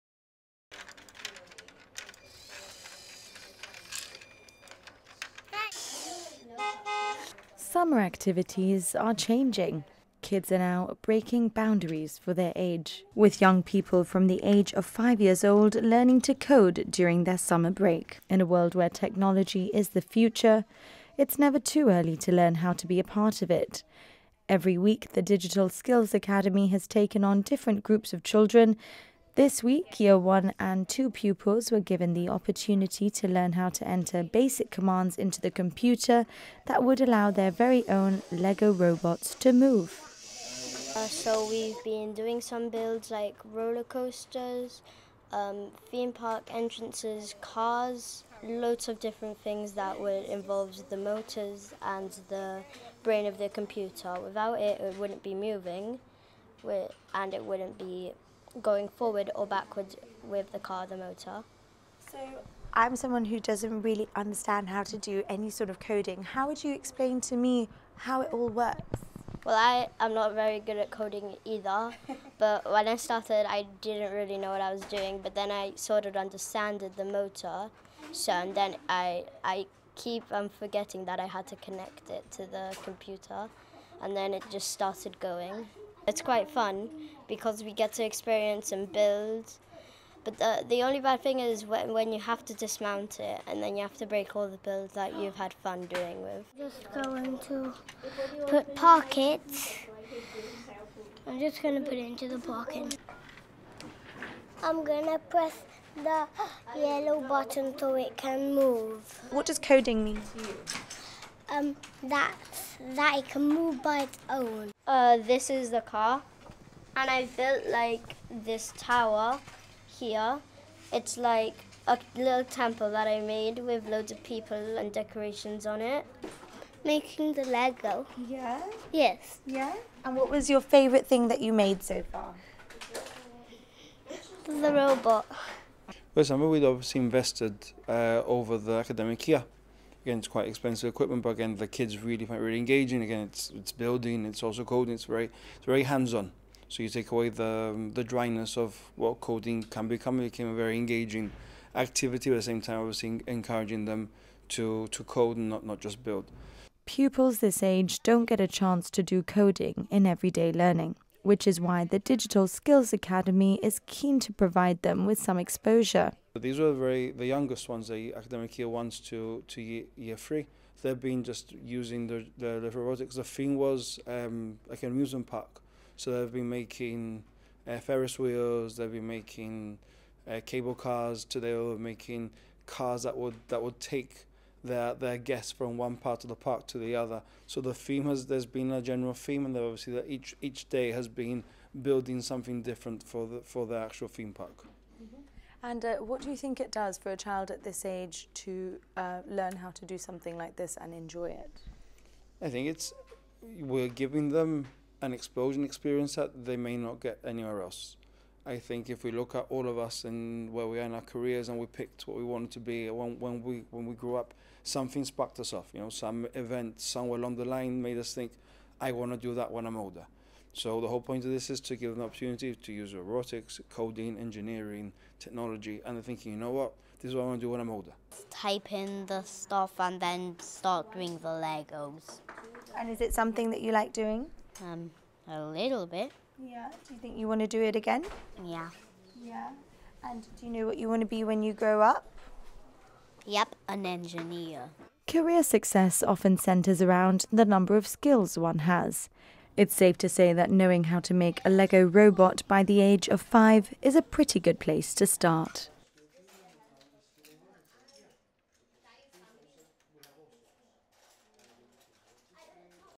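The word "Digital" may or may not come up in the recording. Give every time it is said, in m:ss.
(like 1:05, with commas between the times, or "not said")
0:25, 2:41.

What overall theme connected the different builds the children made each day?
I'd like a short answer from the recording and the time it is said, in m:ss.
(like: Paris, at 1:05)
Amusement park, at 2:54.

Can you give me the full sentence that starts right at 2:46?
These were very the youngest ones, the academic year ones to to year, three.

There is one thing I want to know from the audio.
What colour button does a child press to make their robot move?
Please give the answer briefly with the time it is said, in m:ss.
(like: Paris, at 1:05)
Yellow, at 1:46.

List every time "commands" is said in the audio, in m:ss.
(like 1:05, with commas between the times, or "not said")
0:34.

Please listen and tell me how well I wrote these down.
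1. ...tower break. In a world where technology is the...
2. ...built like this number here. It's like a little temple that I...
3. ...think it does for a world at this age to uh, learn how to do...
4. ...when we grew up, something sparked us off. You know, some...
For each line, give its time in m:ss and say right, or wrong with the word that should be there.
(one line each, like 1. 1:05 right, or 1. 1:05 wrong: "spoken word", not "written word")
1. 0:17 wrong: "summer", not "tower"
2. 1:57 wrong: "tower", not "number"
3. 3:16 wrong: "child", not "world"
4. 3:33 right.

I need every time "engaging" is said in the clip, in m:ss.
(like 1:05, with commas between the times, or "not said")
2:22, 2:30.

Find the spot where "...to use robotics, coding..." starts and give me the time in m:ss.
3:42.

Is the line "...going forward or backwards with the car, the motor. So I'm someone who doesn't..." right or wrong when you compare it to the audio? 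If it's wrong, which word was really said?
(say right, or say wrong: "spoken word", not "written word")
right.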